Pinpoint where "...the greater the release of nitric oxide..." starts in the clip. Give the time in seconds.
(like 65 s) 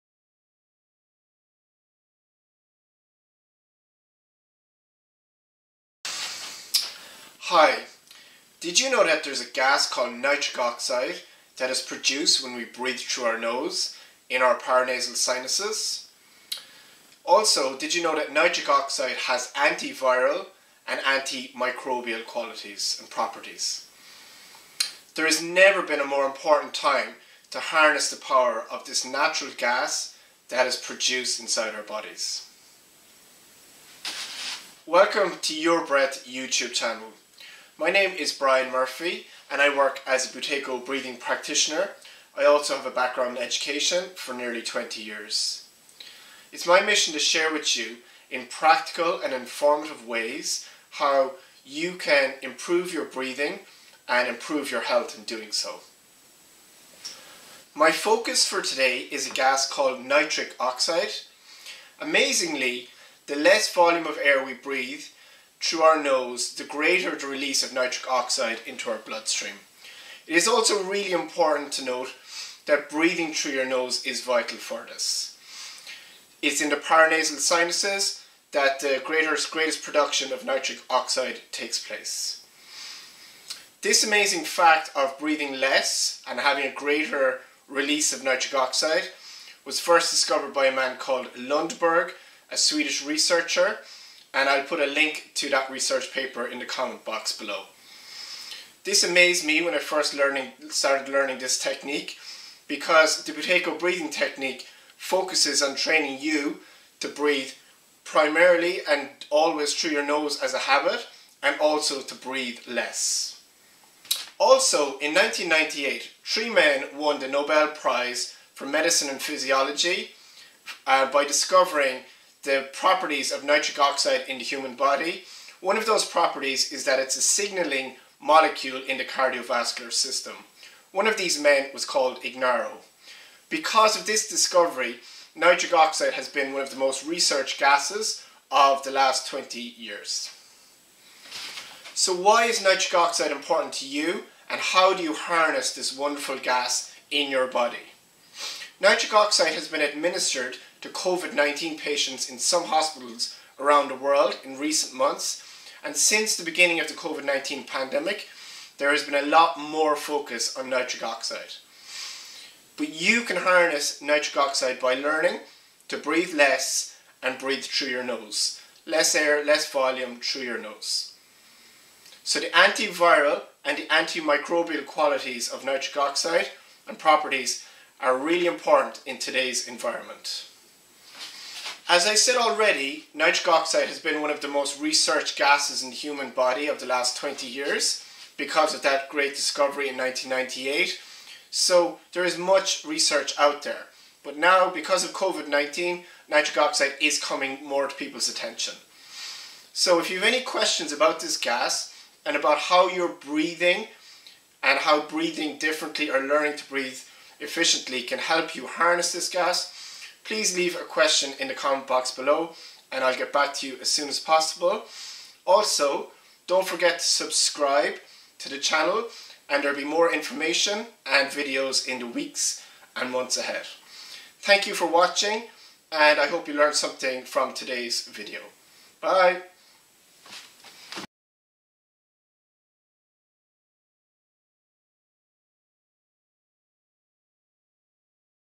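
66 s.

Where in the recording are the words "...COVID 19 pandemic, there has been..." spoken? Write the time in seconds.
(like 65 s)
156 s.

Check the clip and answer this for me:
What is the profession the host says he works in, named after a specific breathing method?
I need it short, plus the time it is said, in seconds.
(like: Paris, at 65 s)
Buteyko breathing practitioner, at 40 s.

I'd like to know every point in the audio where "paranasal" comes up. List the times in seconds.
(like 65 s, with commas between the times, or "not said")
14 s, 76 s.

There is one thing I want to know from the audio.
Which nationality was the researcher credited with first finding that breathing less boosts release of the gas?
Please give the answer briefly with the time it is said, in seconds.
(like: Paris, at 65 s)
Swedish, at 92 s.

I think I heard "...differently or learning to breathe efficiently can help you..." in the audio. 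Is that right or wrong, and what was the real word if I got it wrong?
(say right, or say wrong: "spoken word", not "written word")
right.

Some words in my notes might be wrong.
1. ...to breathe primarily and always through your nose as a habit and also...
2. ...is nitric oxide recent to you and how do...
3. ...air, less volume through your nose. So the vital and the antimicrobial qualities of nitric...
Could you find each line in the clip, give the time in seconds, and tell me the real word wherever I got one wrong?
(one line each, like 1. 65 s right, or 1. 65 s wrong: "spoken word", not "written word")
1. 106 s right
2. 142 s wrong: "important", not "recent"
3. 169 s wrong: "antiviral", not "vital".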